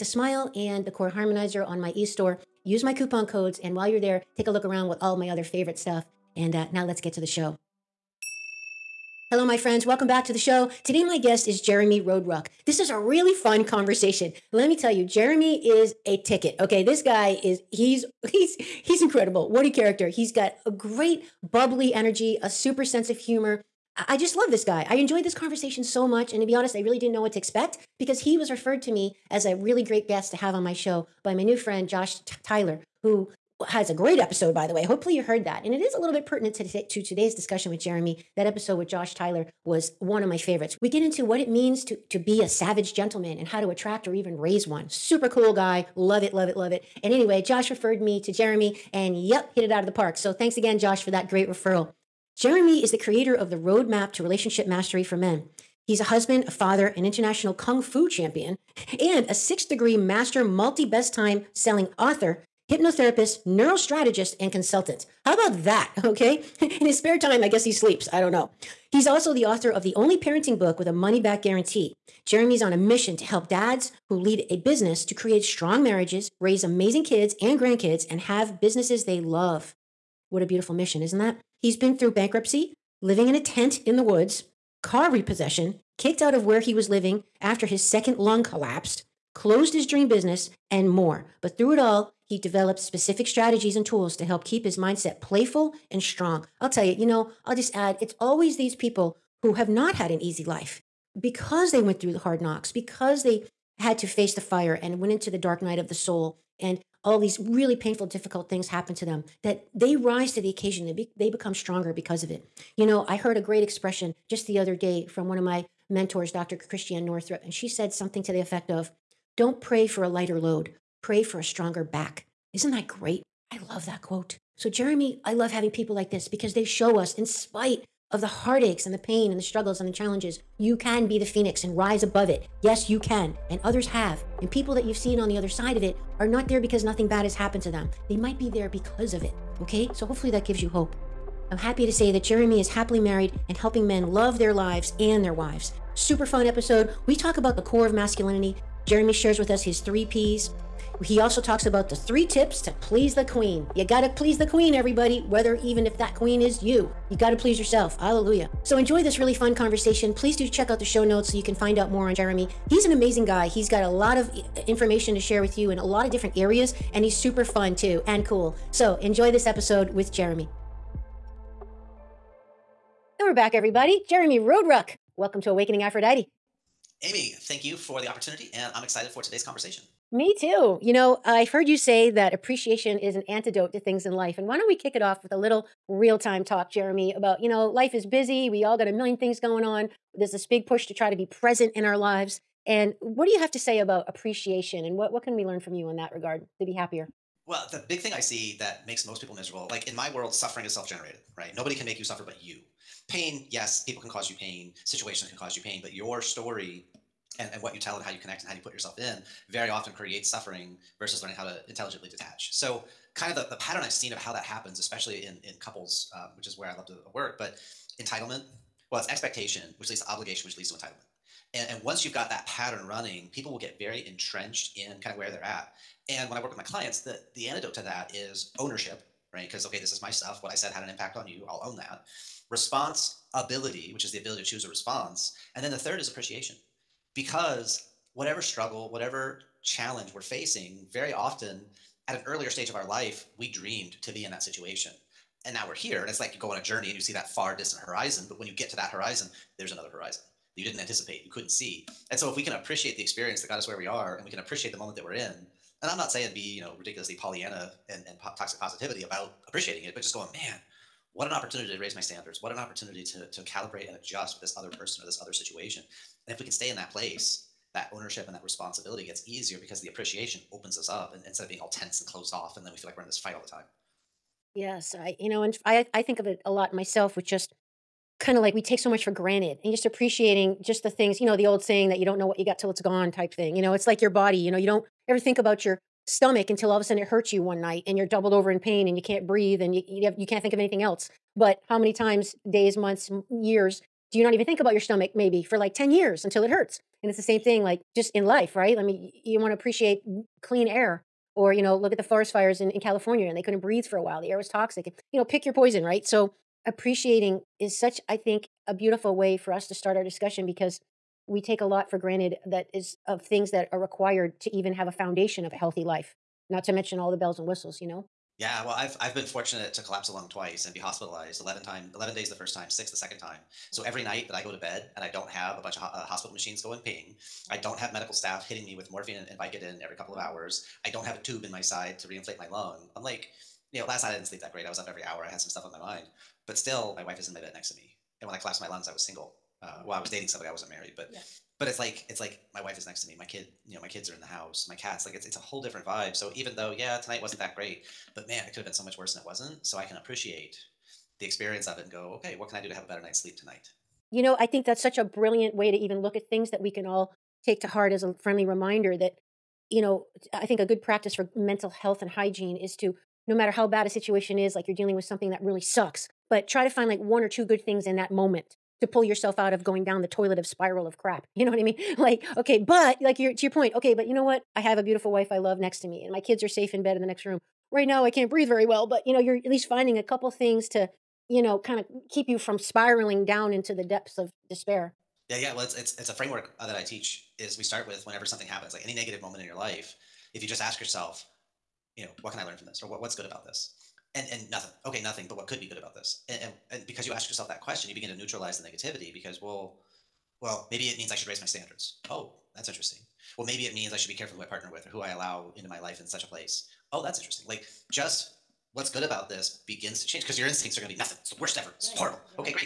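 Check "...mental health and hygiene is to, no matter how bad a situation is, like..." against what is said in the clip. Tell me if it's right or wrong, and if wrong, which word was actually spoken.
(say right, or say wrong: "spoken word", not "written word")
right.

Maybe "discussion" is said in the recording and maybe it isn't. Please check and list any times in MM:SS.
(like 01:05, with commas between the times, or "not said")
00:37, 05:10.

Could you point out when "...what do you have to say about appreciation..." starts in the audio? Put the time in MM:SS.
03:13.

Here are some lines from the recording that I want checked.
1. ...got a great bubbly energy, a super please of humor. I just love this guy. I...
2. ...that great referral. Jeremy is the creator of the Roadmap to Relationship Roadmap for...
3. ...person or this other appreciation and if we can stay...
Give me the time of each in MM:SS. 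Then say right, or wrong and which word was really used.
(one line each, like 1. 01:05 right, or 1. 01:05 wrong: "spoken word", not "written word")
1. 00:20 wrong: "sense", not "please"
2. 00:51 wrong: "Mastery", not "Roadmap"
3. 04:24 wrong: "situation", not "appreciation".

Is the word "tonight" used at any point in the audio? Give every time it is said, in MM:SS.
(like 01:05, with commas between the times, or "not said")
05:46, 05:53.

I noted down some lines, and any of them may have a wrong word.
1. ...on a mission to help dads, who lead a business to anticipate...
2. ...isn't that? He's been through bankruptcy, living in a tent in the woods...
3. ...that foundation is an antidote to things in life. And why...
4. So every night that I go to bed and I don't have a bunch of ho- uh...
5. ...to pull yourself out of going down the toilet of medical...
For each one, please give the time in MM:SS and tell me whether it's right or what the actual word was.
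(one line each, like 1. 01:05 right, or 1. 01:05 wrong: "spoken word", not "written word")
1. 01:12 wrong: "create", not "anticipate"
2. 01:21 right
3. 03:02 wrong: "appreciation", not "foundation"
4. 05:23 right
5. 06:08 wrong: "spiral", not "medical".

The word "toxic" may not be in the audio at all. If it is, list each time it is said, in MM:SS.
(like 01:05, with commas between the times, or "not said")
04:18, 05:04.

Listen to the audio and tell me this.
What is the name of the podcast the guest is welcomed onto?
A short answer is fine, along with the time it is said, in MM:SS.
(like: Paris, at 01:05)
Awakening Aphrodite, at 02:55.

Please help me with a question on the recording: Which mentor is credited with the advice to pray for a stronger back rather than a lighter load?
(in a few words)
Dr. Christiane Northrup.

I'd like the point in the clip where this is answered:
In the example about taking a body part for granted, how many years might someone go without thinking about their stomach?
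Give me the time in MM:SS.
04:55.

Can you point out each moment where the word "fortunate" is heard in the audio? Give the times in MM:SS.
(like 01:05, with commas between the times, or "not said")
05:19.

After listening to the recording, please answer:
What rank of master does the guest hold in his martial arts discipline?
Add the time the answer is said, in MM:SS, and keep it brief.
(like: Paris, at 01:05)
6th degree, at 00:59.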